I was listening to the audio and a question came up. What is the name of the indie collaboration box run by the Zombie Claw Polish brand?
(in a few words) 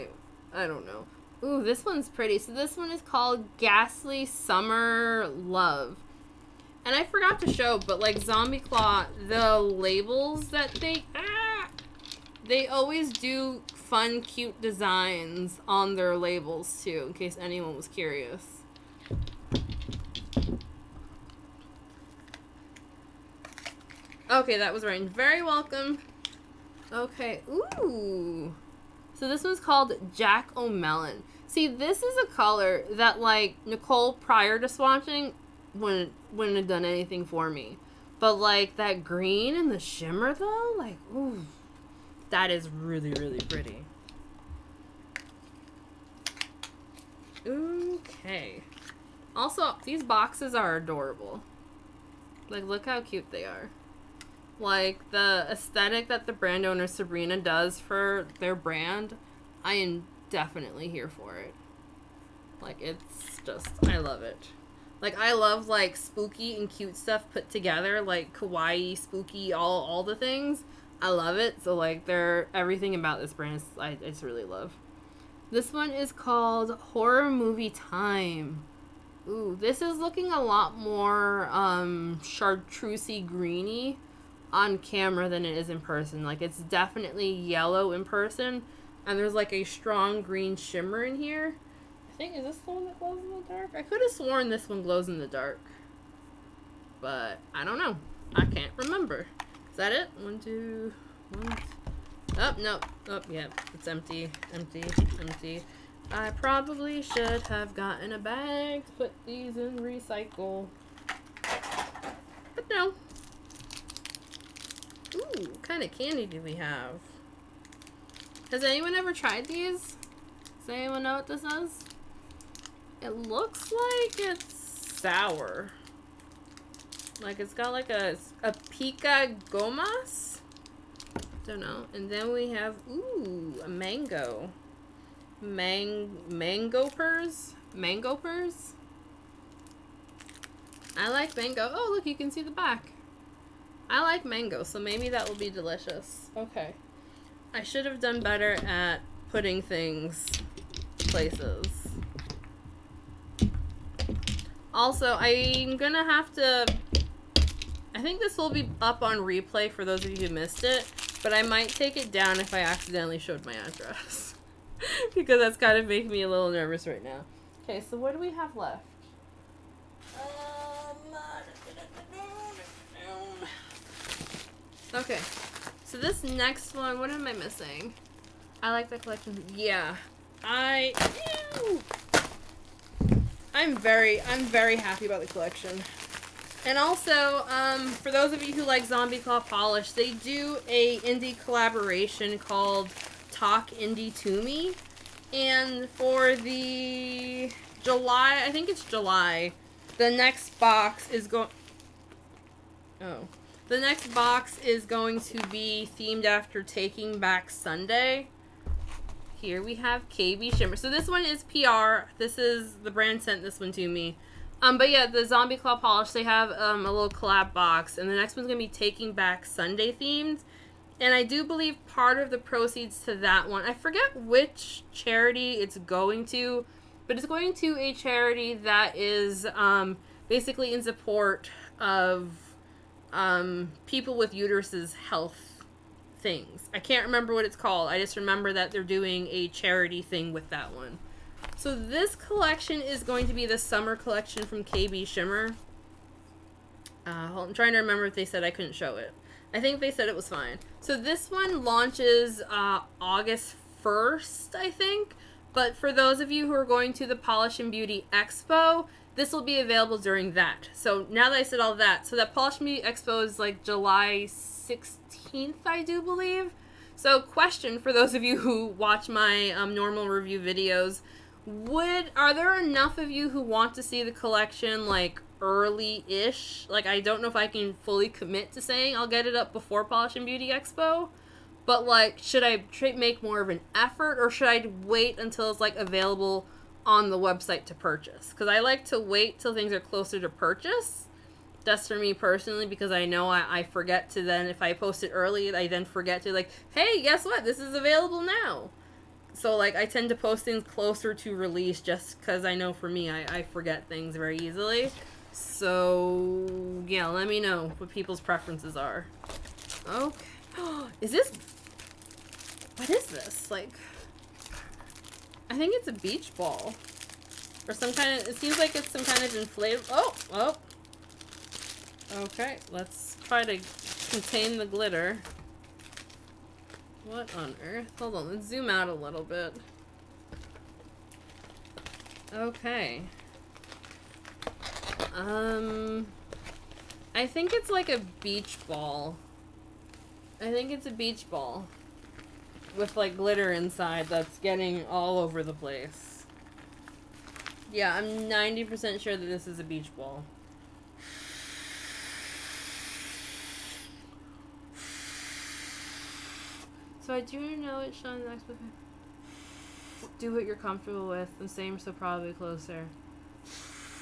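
Talk Indie To Me.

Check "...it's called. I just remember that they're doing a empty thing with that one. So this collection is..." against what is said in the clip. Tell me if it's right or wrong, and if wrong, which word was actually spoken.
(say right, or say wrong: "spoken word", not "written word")
wrong: "charity", not "empty".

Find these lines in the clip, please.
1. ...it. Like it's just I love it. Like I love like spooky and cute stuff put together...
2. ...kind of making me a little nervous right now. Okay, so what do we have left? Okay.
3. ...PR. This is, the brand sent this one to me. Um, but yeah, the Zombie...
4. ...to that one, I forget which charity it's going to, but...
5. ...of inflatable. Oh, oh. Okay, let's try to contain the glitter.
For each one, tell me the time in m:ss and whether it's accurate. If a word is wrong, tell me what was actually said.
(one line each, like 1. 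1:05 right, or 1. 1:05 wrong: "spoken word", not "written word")
1. 1:01 right
2. 2:45 right
3. 3:31 right
4. 3:43 right
5. 5:19 right.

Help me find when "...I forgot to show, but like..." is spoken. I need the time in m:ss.
0:06.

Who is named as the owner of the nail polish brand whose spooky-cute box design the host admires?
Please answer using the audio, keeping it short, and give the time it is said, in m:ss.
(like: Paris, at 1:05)
Sabrina, at 0:56.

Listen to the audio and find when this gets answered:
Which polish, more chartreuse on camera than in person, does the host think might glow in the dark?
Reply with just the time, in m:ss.
1:16.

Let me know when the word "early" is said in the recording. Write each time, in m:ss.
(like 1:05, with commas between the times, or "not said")
4:35, 4:55.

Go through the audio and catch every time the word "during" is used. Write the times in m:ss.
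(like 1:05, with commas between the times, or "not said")
4:19.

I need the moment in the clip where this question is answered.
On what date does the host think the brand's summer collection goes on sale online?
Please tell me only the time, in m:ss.
4:12.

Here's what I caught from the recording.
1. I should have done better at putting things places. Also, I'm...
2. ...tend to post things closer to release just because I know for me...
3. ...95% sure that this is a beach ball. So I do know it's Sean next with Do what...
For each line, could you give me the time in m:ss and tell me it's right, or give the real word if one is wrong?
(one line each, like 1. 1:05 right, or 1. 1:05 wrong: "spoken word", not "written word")
1. 2:27 right
2. 4:59 right
3. 5:48 wrong: "90", not "95".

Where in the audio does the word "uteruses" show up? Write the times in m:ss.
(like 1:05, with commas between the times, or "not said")
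3:54.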